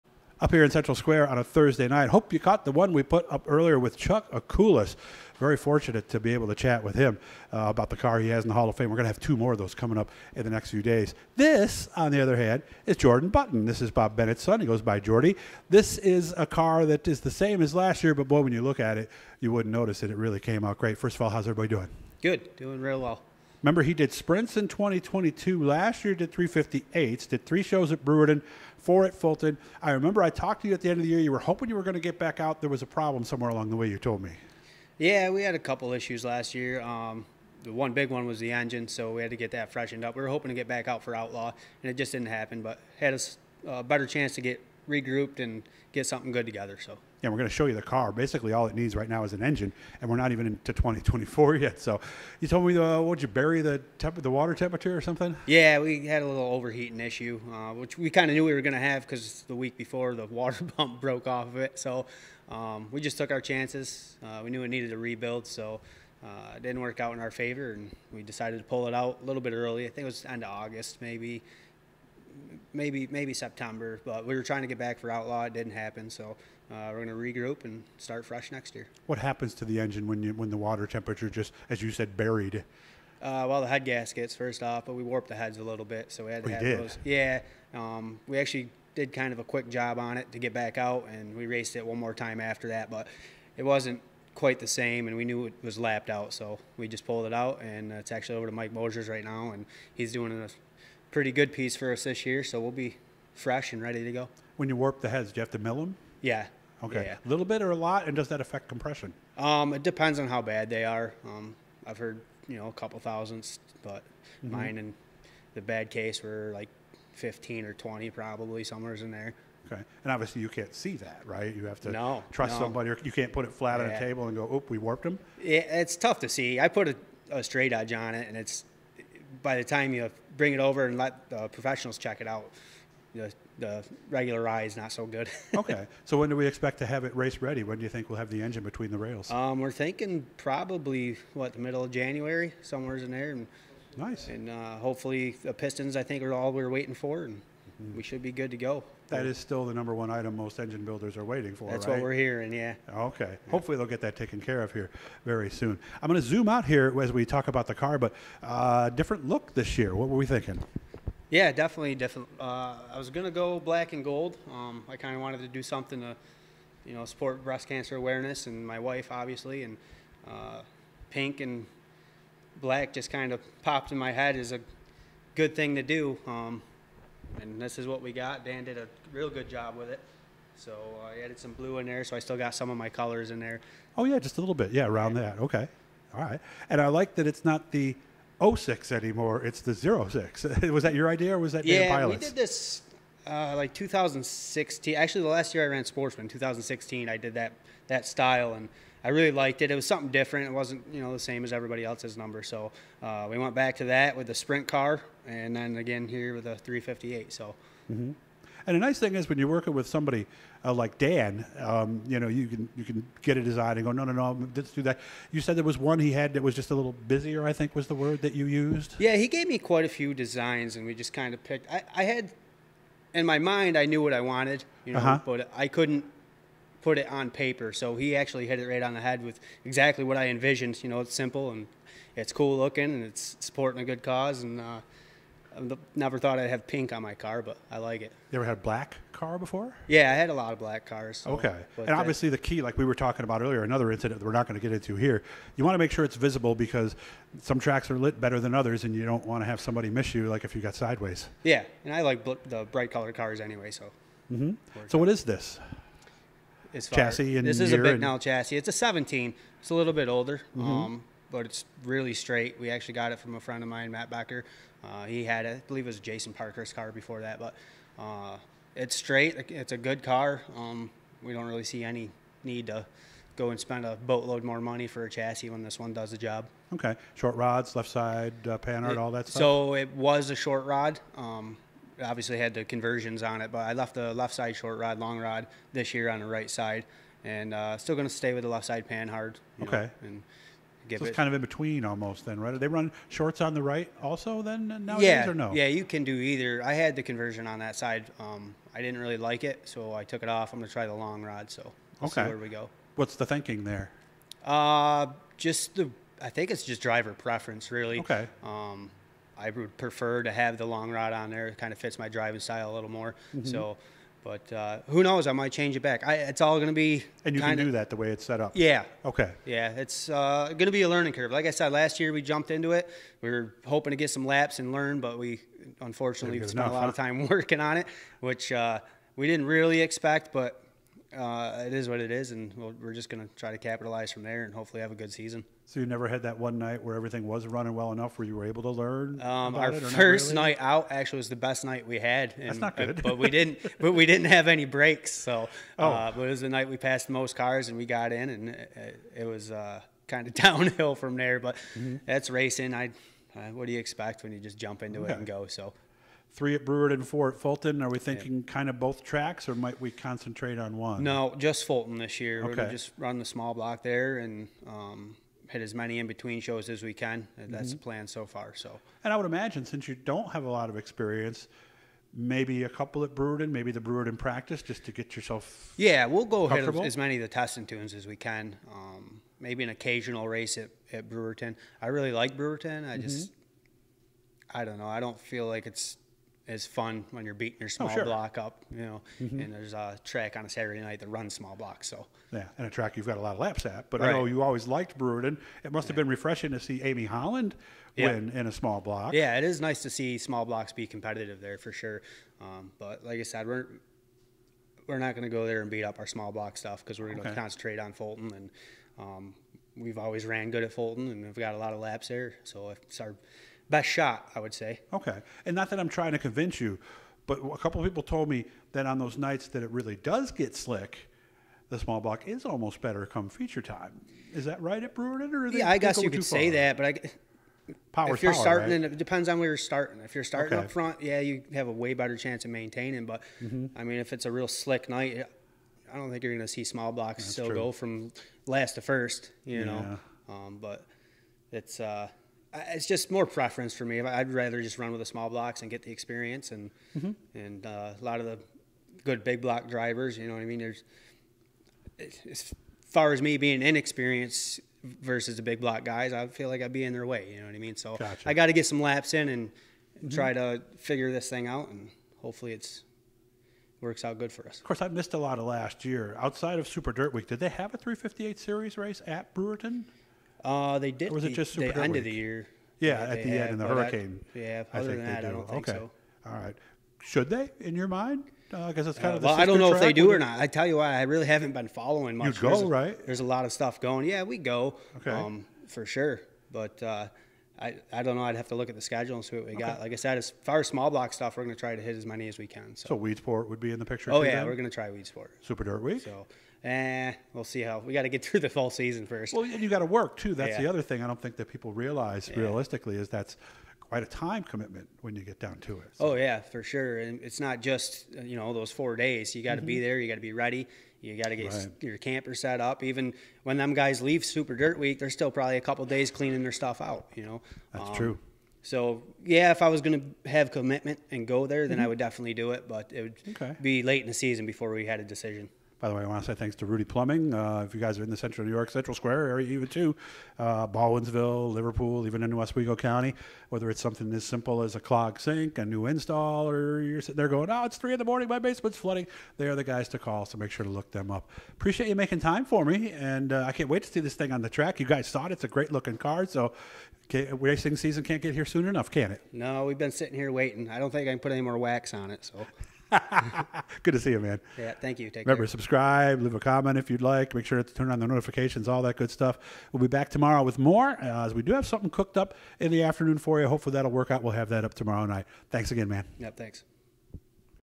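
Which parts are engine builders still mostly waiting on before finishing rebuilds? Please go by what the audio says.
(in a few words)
Pistons.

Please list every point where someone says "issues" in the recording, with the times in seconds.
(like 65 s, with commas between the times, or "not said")
35 s, 56 s.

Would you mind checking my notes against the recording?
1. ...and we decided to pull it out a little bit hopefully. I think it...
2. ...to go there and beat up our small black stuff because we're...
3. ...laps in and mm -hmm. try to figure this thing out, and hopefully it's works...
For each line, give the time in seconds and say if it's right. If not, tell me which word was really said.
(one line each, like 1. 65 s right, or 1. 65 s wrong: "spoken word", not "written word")
1. 67 s wrong: "early", not "hopefully"
2. 405 s wrong: "block", not "black"
3. 458 s right.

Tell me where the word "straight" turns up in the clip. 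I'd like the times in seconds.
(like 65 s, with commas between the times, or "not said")
127 s, 262 s, 268 s.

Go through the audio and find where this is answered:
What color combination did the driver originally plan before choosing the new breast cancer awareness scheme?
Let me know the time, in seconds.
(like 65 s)
163 s.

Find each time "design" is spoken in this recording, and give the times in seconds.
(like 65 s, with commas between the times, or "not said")
213 s, 220 s.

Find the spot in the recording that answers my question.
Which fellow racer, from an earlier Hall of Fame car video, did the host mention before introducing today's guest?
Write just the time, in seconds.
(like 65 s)
3 s.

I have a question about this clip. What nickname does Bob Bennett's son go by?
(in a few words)
Jordy.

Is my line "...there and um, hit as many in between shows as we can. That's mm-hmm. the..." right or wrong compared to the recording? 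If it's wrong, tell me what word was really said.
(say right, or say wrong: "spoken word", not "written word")
right.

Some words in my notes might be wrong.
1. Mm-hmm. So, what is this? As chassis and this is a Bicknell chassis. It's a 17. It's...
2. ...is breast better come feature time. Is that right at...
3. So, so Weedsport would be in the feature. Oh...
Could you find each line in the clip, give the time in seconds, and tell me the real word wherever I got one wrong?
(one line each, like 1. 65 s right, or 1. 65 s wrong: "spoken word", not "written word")
1. 254 s right
2. 422 s wrong: "almost", not "breast"
3. 492 s wrong: "picture", not "feature".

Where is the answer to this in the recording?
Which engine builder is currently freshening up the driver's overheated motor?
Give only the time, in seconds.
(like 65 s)
98 s.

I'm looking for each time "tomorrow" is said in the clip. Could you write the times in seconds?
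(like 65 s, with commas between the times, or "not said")
560 s, 564 s.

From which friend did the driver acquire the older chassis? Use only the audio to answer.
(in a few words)
Matt Becker.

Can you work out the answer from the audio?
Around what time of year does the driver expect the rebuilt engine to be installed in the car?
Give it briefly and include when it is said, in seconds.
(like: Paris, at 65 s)
Middle of January, at 141 s.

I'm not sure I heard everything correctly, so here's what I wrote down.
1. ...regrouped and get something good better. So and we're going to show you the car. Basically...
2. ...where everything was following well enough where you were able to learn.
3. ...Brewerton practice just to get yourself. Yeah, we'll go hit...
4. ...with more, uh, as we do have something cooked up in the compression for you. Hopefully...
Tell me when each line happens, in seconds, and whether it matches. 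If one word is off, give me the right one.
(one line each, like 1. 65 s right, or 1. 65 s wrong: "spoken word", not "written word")
1. 44 s wrong: "together", not "better"
2. 336 s wrong: "running", not "following"
3. 373 s right
4. 560 s wrong: "afternoon", not "compression".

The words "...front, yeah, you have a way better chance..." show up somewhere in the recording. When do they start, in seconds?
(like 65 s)
430 s.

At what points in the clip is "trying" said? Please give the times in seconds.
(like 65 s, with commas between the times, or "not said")
74 s, 415 s.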